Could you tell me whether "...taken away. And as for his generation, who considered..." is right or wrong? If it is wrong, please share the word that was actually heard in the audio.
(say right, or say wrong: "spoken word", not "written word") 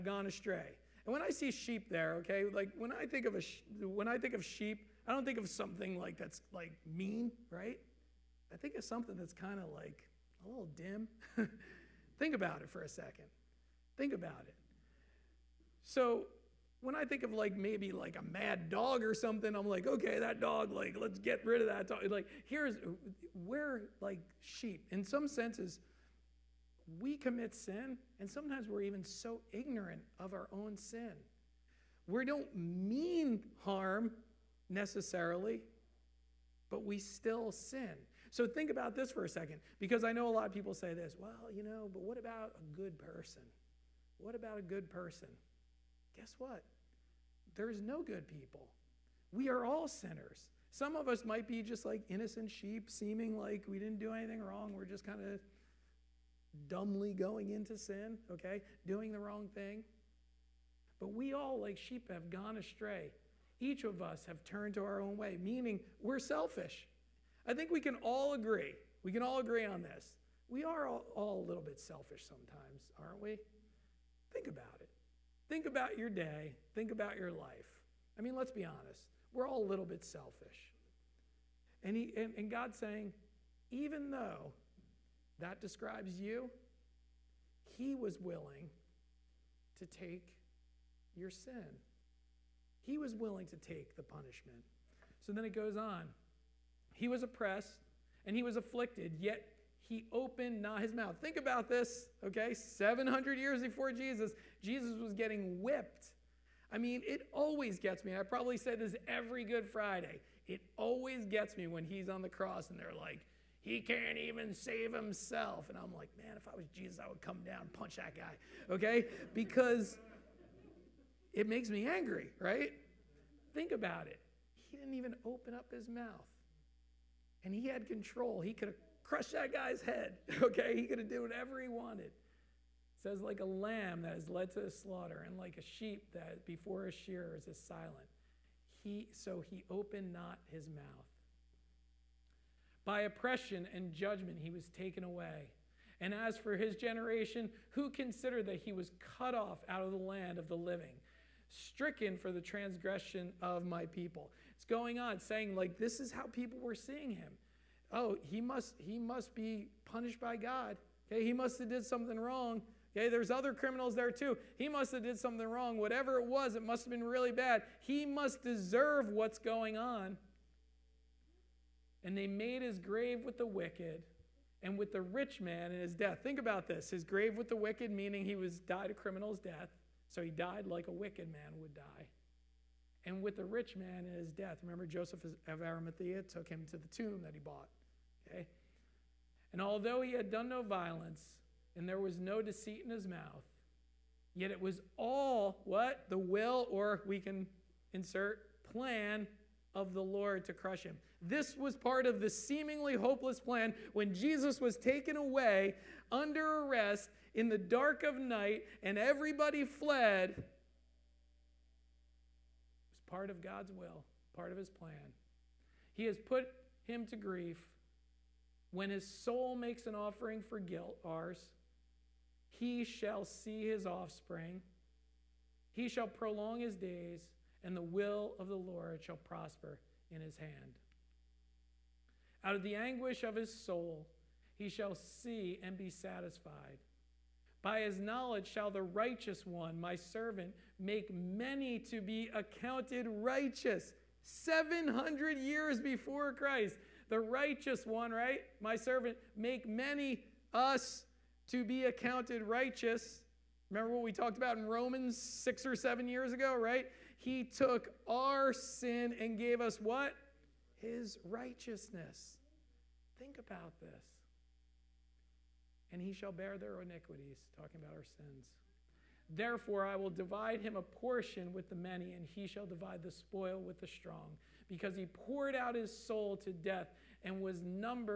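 right.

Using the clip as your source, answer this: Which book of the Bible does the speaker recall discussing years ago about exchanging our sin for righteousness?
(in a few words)
Romans.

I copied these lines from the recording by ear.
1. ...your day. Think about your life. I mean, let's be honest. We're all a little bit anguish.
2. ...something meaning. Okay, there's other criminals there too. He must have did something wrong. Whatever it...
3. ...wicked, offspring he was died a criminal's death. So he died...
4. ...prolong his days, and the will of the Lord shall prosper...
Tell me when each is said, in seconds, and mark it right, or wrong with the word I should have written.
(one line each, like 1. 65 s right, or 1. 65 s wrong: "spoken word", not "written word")
1. 75 s wrong: "selfish", not "anguish"
2. 161 s wrong: "wrong", not "meaning"
3. 177 s wrong: "meaning", not "offspring"
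4. 226 s right.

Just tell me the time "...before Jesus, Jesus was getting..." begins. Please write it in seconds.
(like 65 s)
103 s.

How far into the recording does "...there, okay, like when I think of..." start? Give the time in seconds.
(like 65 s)
1 s.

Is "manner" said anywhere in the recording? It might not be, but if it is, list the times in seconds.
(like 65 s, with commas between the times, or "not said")
not said.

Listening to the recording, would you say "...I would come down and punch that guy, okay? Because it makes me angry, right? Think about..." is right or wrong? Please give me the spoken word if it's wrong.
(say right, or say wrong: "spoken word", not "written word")
right.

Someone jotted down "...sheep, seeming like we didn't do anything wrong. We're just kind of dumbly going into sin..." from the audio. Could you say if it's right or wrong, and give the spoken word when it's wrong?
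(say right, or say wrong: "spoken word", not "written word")
right.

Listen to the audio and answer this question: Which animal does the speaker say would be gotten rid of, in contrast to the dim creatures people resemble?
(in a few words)
mad dog.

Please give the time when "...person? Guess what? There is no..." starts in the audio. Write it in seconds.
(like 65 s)
44 s.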